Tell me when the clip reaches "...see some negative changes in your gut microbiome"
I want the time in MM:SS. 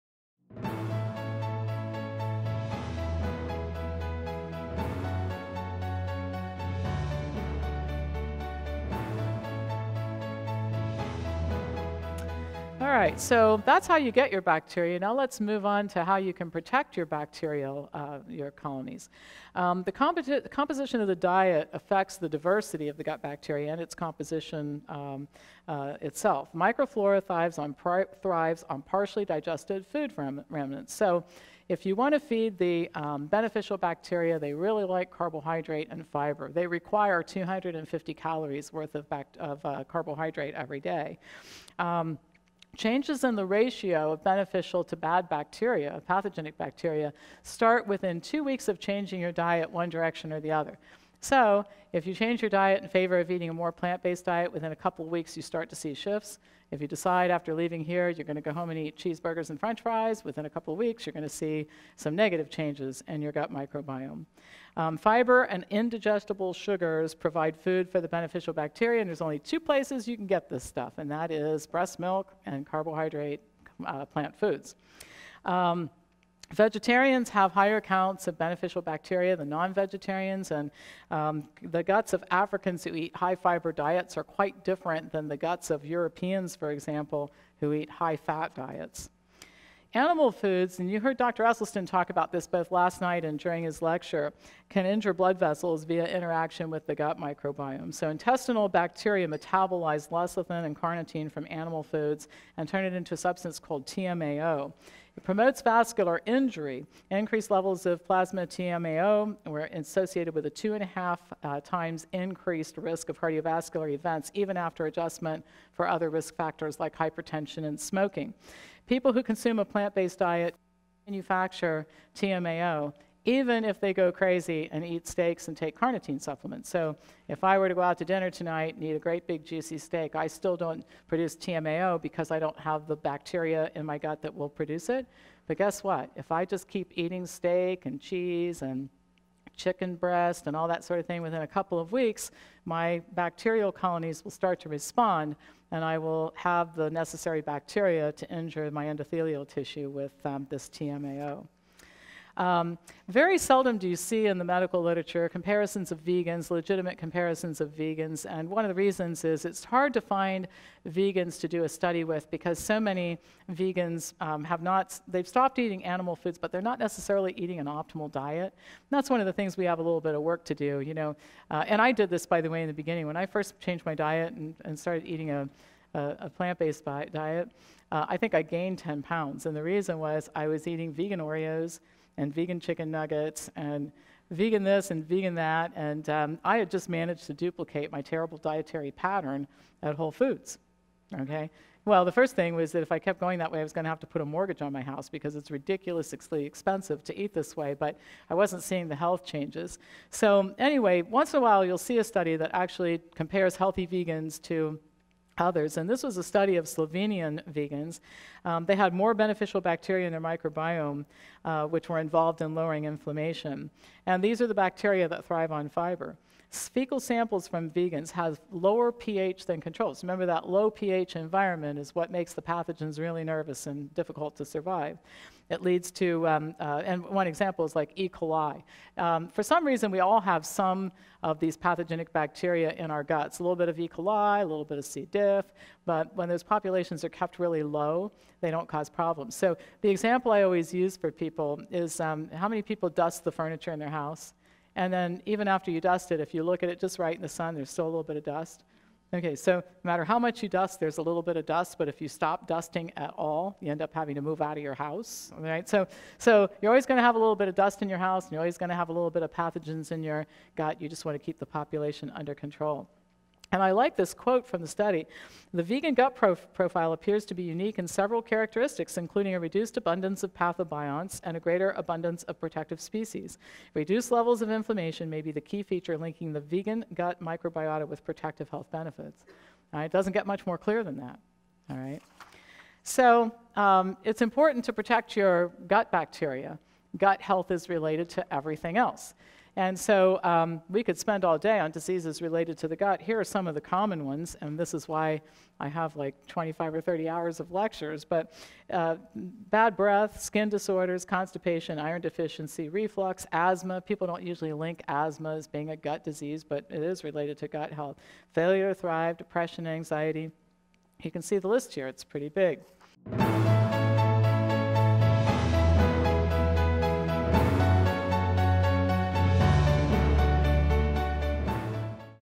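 01:01.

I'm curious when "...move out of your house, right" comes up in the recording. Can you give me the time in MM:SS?
04:14.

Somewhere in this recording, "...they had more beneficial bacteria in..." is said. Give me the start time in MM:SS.
03:28.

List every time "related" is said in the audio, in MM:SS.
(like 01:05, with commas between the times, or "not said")
04:47, 04:52, 05:07.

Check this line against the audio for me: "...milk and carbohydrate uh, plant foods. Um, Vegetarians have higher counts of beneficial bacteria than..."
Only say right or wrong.
right.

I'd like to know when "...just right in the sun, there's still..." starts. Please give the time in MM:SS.
04:06.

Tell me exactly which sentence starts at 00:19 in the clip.
Um, the, composition of the diet affects the diversity of the gut bacteria and its composition um, uh, itself.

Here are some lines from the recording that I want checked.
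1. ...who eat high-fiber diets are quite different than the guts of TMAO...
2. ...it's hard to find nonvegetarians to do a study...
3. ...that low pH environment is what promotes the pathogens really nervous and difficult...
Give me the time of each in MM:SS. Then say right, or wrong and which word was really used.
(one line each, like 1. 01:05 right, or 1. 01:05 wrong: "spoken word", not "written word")
1. 01:22 wrong: "Europeans", not "TMAO"
2. 02:39 wrong: "vegans", not "nonvegetarians"
3. 03:40 wrong: "makes", not "promotes".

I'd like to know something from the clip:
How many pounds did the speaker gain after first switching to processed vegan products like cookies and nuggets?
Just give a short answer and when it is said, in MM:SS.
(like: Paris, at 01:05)
10, at 02:58.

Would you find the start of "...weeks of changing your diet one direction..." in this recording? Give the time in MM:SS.
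00:48.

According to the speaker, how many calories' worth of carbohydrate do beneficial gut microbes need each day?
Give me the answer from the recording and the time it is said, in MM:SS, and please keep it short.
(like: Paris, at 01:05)
250, at 00:37.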